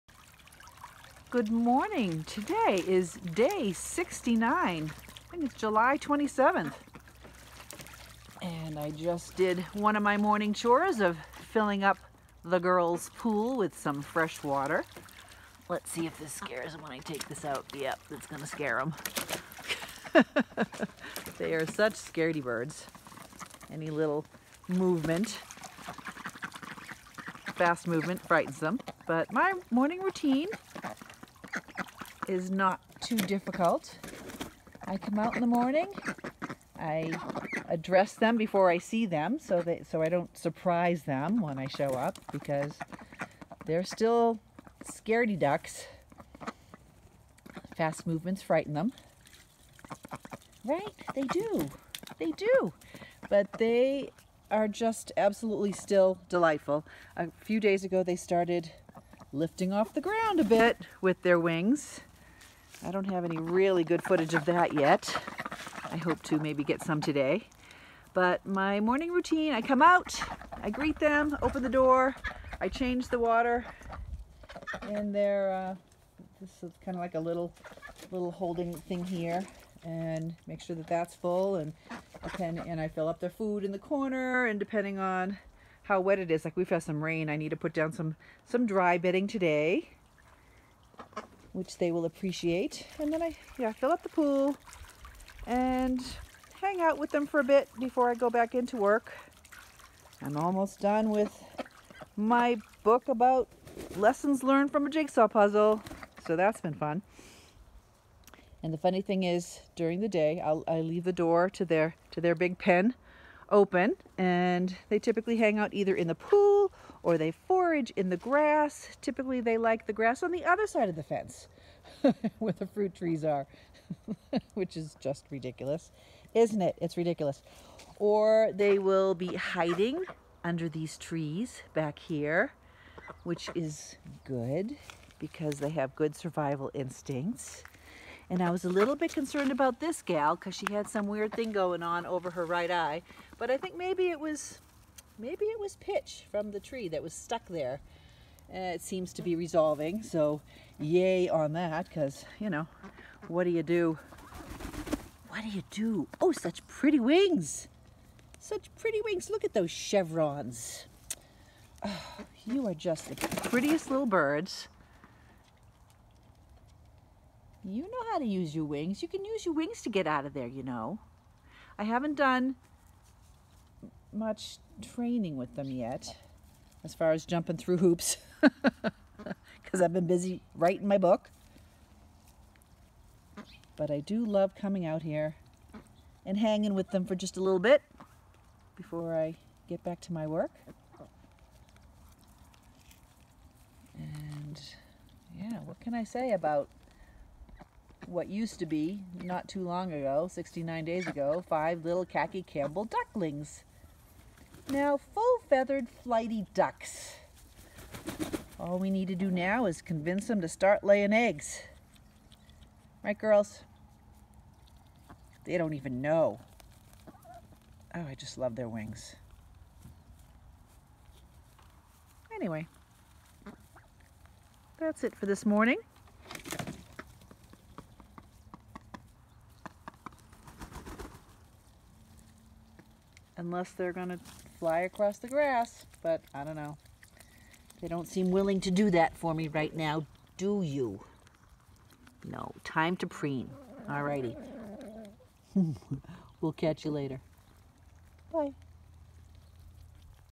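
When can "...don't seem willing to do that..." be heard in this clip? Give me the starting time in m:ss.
3:57.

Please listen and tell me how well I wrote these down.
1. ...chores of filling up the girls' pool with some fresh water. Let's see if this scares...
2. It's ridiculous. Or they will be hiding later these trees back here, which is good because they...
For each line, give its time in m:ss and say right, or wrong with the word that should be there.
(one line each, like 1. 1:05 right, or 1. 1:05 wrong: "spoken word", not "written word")
1. 0:10 right
2. 2:06 wrong: "under", not "later".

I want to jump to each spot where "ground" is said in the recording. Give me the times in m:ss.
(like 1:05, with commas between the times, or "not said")
1:00.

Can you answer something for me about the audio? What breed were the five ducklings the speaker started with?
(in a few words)
Khaki Campbell.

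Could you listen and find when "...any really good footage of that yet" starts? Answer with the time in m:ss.
1:03.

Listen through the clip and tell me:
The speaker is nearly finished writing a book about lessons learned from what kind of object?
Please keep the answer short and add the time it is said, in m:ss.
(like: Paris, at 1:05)
A jigsaw puzzle, at 1:44.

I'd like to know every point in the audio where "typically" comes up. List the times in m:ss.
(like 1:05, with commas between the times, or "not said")
1:54, 1:59.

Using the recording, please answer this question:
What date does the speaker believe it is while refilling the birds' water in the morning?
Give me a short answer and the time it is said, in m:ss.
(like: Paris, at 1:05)
July 27th, at 0:05.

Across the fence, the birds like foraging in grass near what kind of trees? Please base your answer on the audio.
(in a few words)
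Fruit trees.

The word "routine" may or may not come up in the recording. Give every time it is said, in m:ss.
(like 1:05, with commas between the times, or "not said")
0:30, 1:09.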